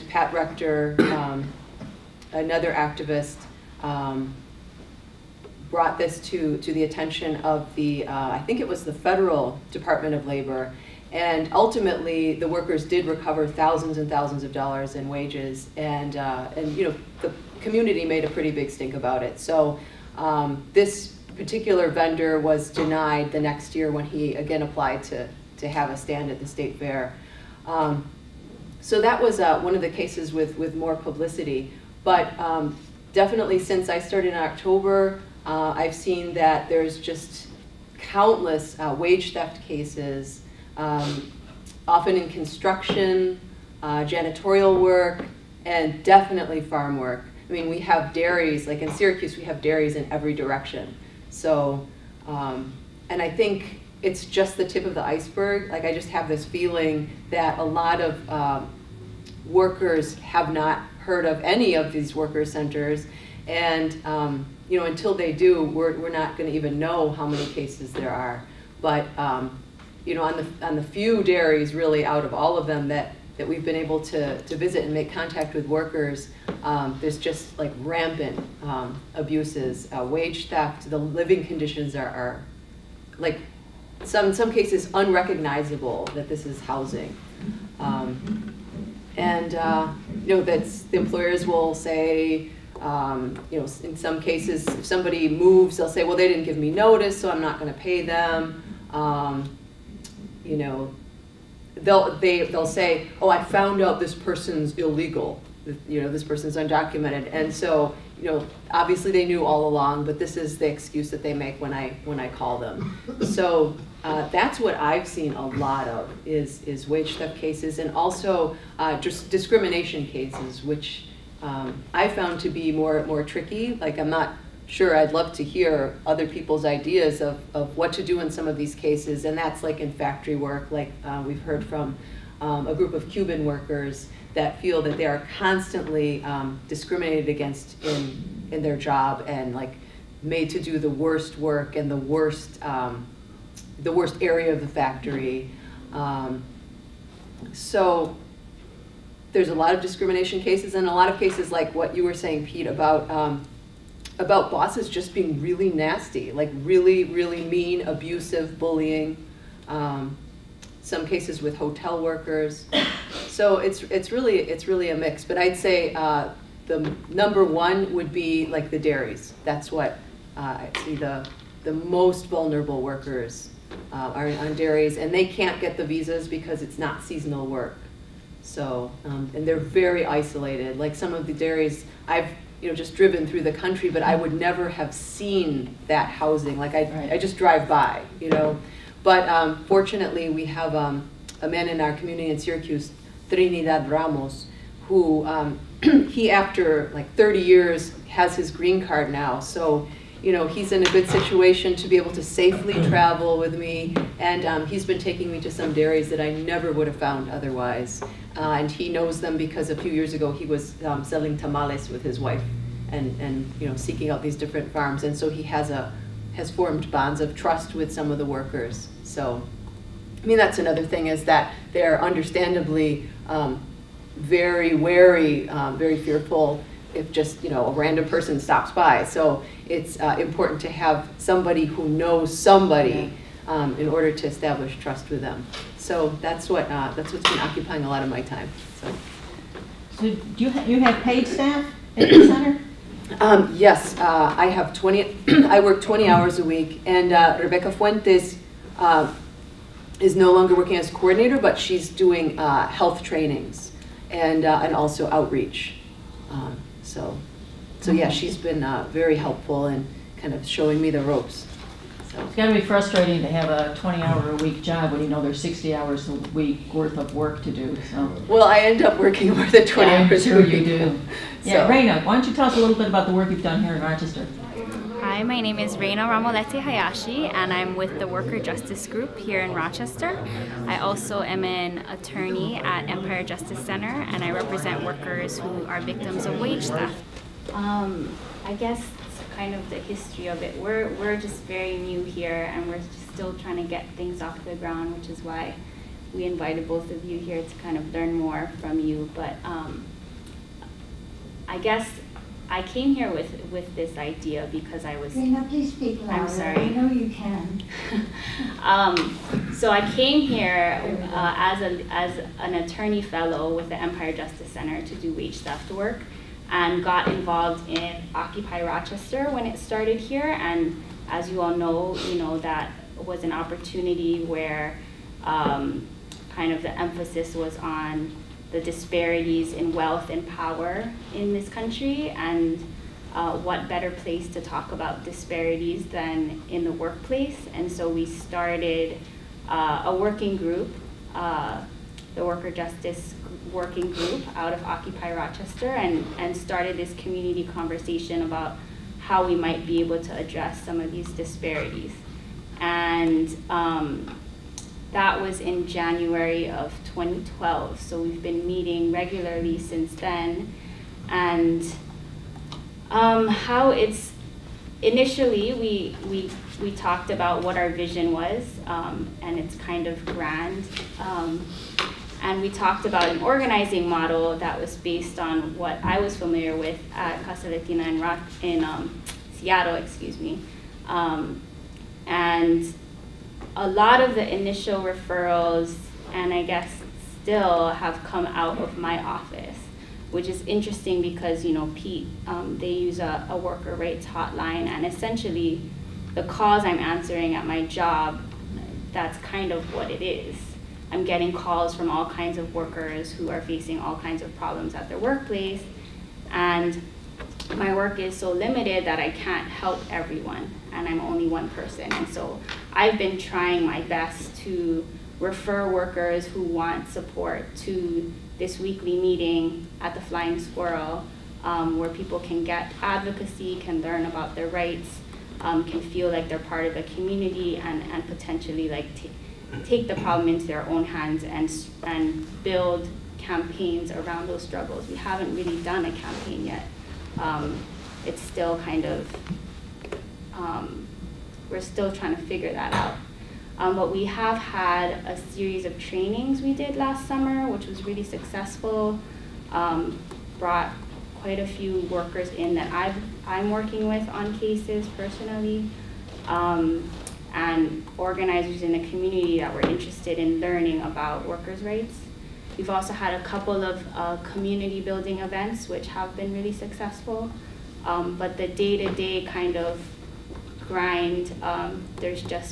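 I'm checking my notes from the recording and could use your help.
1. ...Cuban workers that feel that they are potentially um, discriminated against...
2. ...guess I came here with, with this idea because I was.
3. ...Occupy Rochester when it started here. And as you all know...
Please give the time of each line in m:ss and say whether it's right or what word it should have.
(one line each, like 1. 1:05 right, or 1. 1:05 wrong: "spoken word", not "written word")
1. 2:13 wrong: "constantly", not "potentially"
2. 5:01 right
3. 5:18 right.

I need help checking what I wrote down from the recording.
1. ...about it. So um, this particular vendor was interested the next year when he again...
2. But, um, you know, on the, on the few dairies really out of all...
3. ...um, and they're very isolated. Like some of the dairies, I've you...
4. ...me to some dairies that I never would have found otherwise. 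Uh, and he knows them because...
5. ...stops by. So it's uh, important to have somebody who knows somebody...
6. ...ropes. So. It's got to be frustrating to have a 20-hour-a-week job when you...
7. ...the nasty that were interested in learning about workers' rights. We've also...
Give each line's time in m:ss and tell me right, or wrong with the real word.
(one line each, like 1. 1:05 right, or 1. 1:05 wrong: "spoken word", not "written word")
1. 0:18 wrong: "denied", not "interested"
2. 1:08 right
3. 2:59 right
4. 3:25 right
5. 3:48 right
6. 4:21 right
7. 7:38 wrong: "community", not "nasty".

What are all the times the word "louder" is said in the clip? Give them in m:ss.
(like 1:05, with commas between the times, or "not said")
5:06.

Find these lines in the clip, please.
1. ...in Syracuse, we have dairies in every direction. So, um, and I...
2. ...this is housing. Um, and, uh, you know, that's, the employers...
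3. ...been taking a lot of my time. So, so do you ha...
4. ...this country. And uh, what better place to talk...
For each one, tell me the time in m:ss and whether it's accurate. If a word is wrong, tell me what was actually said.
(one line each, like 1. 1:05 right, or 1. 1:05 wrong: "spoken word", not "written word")
1. 0:48 right
2. 1:26 right
3. 3:57 wrong: "occupying", not "taking"
4. 5:31 right.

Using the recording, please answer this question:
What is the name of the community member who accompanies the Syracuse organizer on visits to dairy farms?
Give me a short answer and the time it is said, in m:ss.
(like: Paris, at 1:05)
Trinidad Ramos, at 3:13.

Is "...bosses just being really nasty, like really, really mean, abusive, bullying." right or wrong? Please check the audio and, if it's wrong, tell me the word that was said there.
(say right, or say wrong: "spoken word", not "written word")
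right.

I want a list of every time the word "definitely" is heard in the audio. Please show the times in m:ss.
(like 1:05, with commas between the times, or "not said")
0:33, 0:46.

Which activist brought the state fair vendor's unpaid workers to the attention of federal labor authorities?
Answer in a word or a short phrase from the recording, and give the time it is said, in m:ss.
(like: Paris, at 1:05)
Pat Rector, at 0:00.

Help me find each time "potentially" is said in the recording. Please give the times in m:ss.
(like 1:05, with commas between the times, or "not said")
7:08.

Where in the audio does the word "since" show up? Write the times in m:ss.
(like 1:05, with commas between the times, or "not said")
0:33, 5:59.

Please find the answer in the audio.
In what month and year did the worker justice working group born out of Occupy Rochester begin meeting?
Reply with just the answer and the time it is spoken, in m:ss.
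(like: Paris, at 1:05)
January 2012, at 5:55.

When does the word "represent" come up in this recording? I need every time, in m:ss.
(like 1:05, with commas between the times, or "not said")
4:44.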